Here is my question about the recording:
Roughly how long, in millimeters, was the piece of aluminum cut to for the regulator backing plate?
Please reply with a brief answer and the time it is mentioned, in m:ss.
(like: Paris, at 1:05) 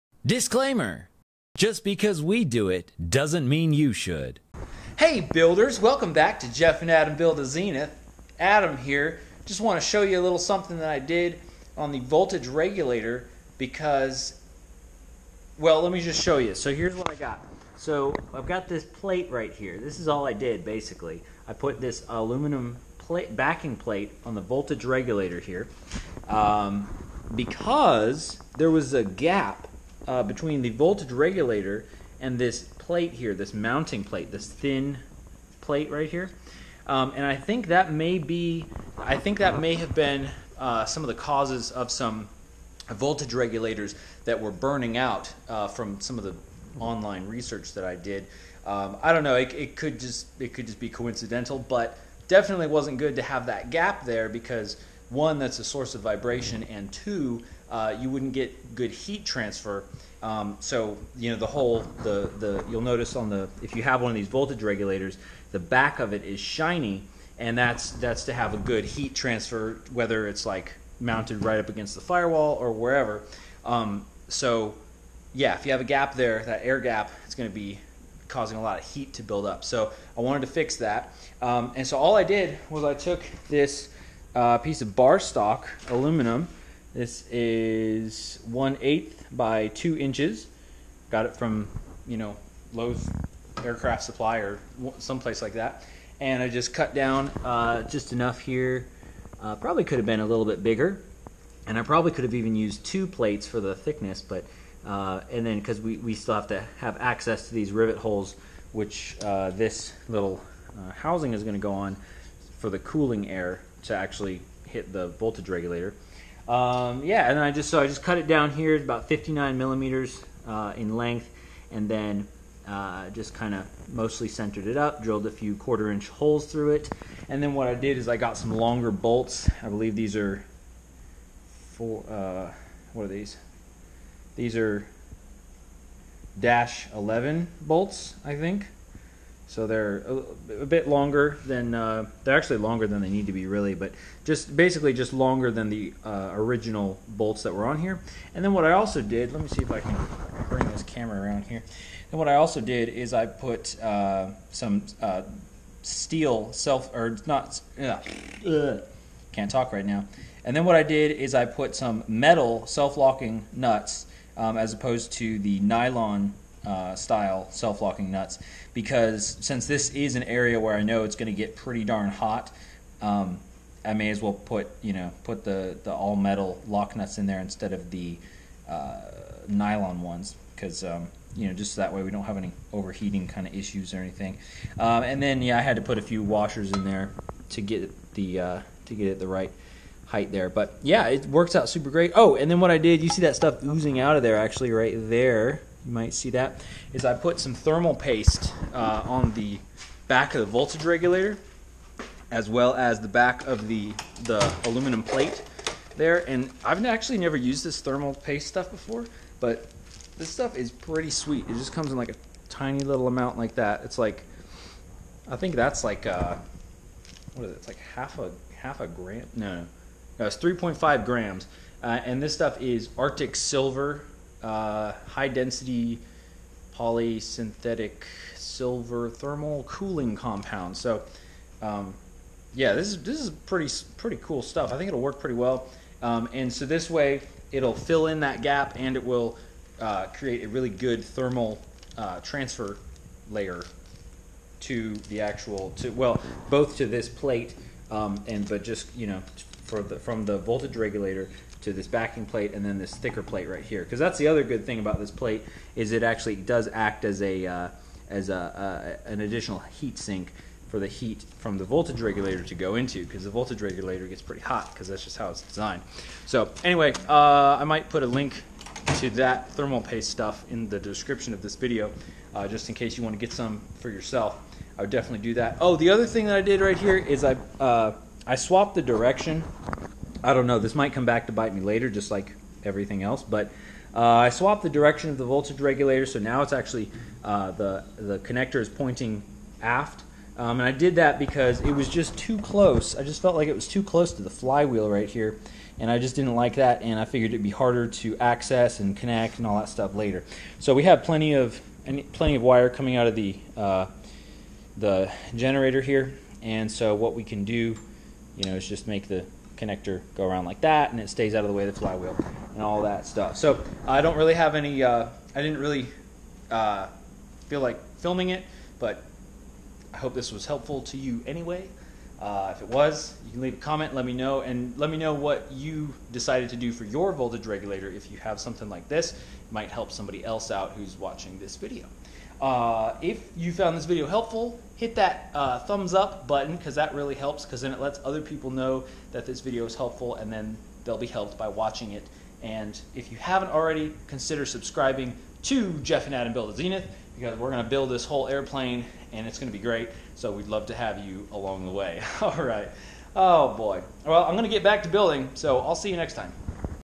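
59 millimeters, at 1:59.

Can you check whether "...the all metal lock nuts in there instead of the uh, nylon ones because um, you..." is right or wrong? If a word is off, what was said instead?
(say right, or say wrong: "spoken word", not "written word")
right.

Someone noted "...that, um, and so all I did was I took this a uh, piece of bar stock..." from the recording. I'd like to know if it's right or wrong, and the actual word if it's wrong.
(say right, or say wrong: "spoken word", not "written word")
right.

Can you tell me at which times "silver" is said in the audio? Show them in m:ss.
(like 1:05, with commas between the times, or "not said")
3:43, 3:48.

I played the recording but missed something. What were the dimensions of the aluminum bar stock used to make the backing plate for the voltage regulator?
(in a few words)
1/8 by 2 inches.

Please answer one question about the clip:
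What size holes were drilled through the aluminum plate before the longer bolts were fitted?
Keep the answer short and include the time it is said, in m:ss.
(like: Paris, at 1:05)
quarter inch, at 2:05.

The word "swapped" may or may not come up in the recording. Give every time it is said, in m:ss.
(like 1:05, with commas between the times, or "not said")
4:38, 4:44.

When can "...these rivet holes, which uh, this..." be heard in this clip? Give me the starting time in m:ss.
1:47.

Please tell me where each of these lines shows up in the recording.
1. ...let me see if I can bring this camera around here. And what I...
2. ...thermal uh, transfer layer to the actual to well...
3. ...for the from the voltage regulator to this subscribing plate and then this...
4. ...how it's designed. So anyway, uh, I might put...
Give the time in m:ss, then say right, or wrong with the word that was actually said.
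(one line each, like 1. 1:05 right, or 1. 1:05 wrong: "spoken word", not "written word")
1. 2:29 right
2. 4:01 right
3. 4:09 wrong: "backing", not "subscribing"
4. 4:25 right.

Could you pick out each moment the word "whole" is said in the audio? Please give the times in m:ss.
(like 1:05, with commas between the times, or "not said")
1:01, 5:48.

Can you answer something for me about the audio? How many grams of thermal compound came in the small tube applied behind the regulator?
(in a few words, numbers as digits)
3.5 grams.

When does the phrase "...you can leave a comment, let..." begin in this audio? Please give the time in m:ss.
5:23.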